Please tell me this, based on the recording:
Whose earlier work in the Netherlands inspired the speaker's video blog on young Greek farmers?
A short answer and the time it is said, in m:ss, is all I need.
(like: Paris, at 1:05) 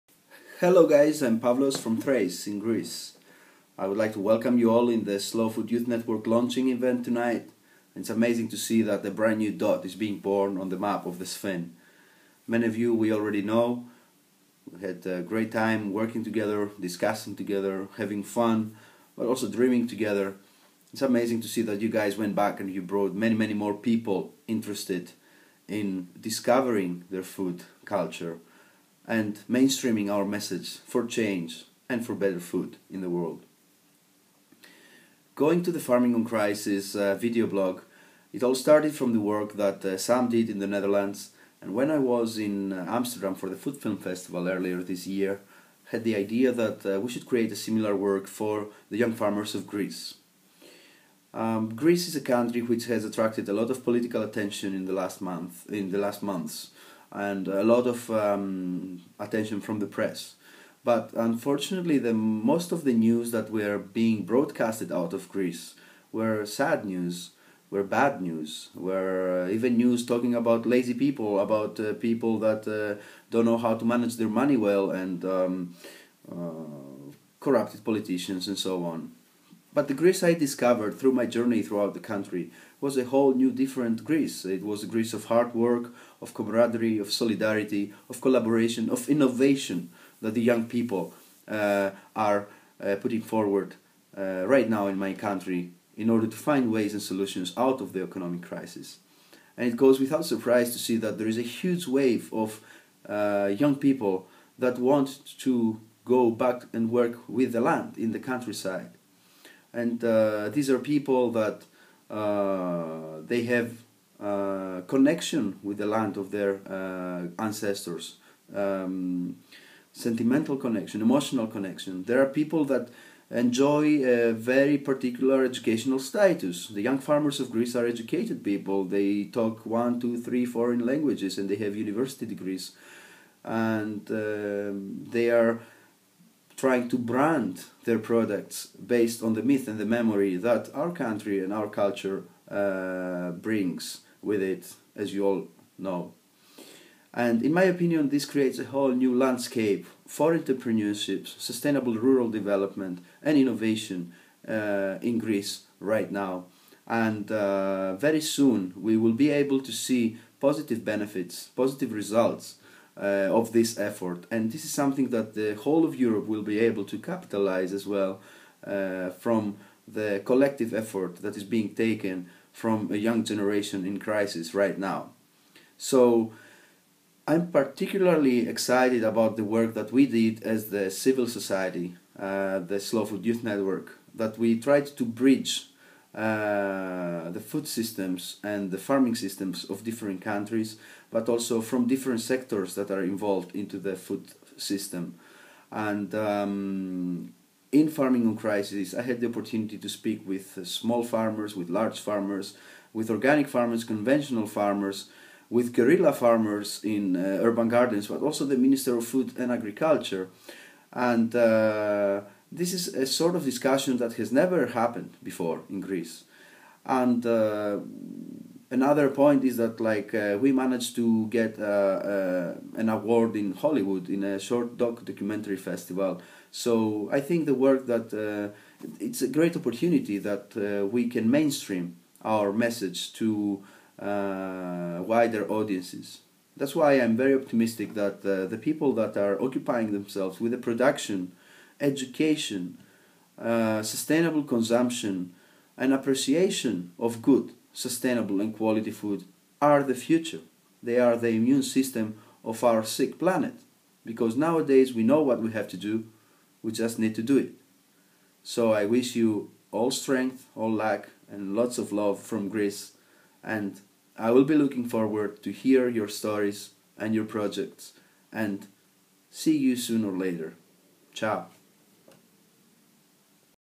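Sam, at 0:39.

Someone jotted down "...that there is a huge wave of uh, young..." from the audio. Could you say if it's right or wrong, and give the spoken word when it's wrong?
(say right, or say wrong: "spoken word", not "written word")
right.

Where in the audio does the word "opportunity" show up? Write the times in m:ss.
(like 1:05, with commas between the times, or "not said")
3:19, 3:49.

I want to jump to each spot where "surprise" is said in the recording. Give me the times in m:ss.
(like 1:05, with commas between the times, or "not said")
1:40.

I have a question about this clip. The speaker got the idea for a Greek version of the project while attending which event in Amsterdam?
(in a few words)
Food Film Festival.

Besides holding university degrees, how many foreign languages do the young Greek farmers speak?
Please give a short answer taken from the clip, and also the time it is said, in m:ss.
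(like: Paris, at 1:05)
1, 2, 3, at 2:09.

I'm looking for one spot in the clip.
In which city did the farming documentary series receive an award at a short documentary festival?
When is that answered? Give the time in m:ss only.
3:43.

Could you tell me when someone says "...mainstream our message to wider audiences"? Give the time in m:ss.
3:51.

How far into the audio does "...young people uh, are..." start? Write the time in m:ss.
1:30.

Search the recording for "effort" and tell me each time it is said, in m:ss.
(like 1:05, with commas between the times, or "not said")
2:43, 2:50.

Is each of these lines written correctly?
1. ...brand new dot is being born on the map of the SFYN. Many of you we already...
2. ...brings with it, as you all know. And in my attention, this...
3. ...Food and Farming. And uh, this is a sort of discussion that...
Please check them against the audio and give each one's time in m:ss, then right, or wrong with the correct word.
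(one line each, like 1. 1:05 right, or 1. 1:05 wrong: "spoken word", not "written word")
1. 0:09 right
2. 2:23 wrong: "opinion", not "attention"
3. 3:29 wrong: "Agriculture", not "Farming".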